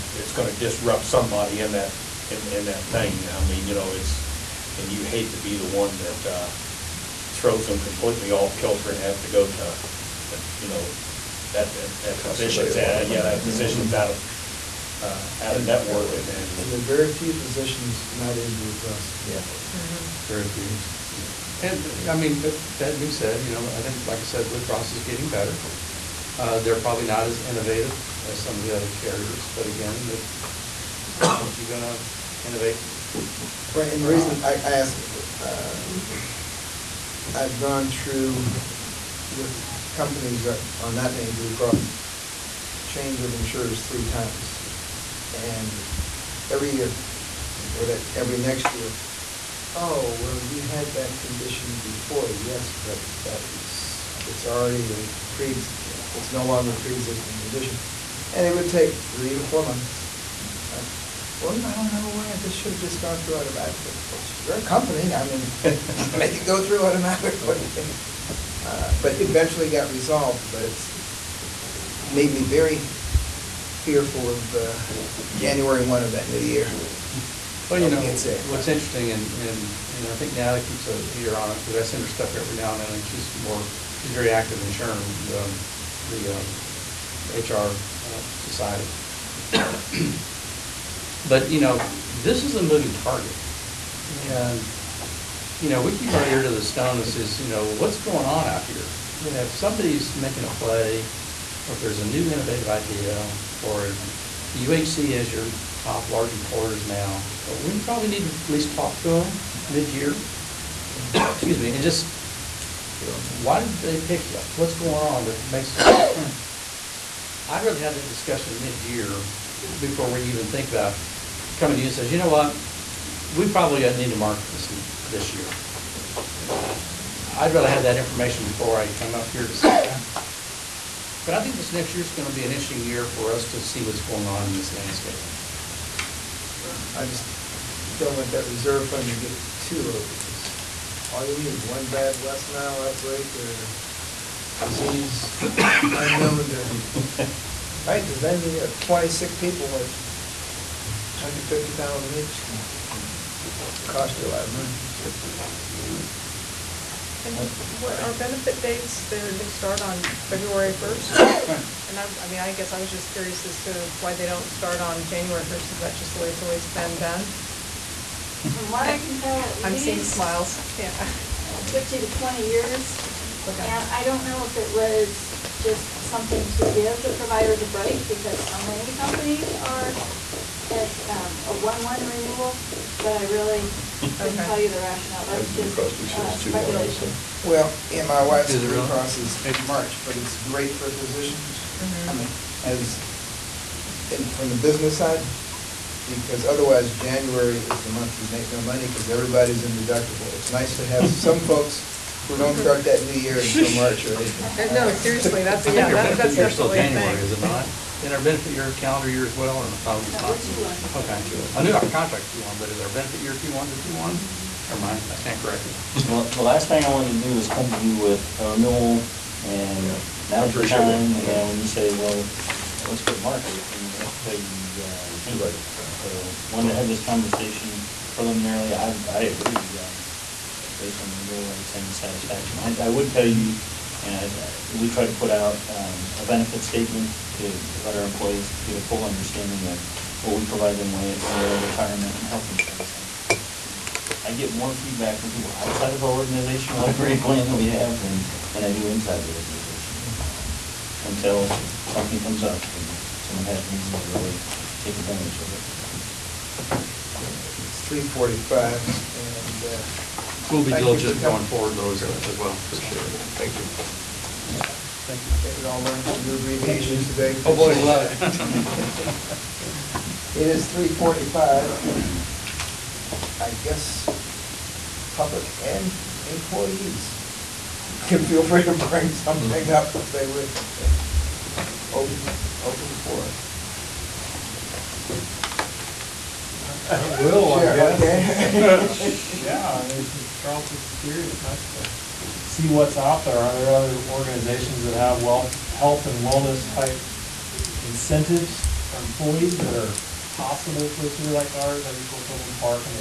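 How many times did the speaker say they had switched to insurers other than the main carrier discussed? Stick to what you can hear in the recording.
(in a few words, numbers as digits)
3.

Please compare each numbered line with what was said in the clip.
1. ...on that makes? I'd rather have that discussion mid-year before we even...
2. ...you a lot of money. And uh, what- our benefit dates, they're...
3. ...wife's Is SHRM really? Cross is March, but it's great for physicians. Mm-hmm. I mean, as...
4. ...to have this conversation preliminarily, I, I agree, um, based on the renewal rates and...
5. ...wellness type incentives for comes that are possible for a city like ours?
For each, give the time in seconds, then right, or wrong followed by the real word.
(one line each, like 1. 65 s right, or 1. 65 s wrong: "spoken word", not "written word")
1. 114 s right
2. 154 s right
3. 188 s wrong: "Blue", not "SHRM"
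4. 226 s right
5. 296 s wrong: "employees", not "comes".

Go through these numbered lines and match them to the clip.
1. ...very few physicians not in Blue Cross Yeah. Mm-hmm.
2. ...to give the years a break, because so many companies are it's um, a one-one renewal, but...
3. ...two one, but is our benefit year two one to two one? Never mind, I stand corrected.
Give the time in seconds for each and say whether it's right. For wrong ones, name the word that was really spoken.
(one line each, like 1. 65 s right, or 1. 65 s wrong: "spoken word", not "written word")
1. 16 s right
2. 176 s wrong: "providers", not "years"
3. 212 s right.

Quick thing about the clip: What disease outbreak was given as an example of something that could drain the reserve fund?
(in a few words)
West Nile.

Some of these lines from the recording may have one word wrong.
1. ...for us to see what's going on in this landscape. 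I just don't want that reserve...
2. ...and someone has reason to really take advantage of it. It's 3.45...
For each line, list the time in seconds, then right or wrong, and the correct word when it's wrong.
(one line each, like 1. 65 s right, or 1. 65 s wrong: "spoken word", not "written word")
1. 133 s right
2. 252 s right.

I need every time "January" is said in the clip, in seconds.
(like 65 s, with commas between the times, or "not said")
75 s, 165 s, 196 s, 206 s.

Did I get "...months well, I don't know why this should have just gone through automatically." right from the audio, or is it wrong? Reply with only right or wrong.
right.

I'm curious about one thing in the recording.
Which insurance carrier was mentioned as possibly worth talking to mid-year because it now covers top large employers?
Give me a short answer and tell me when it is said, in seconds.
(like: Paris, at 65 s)
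UHC, at 104 s.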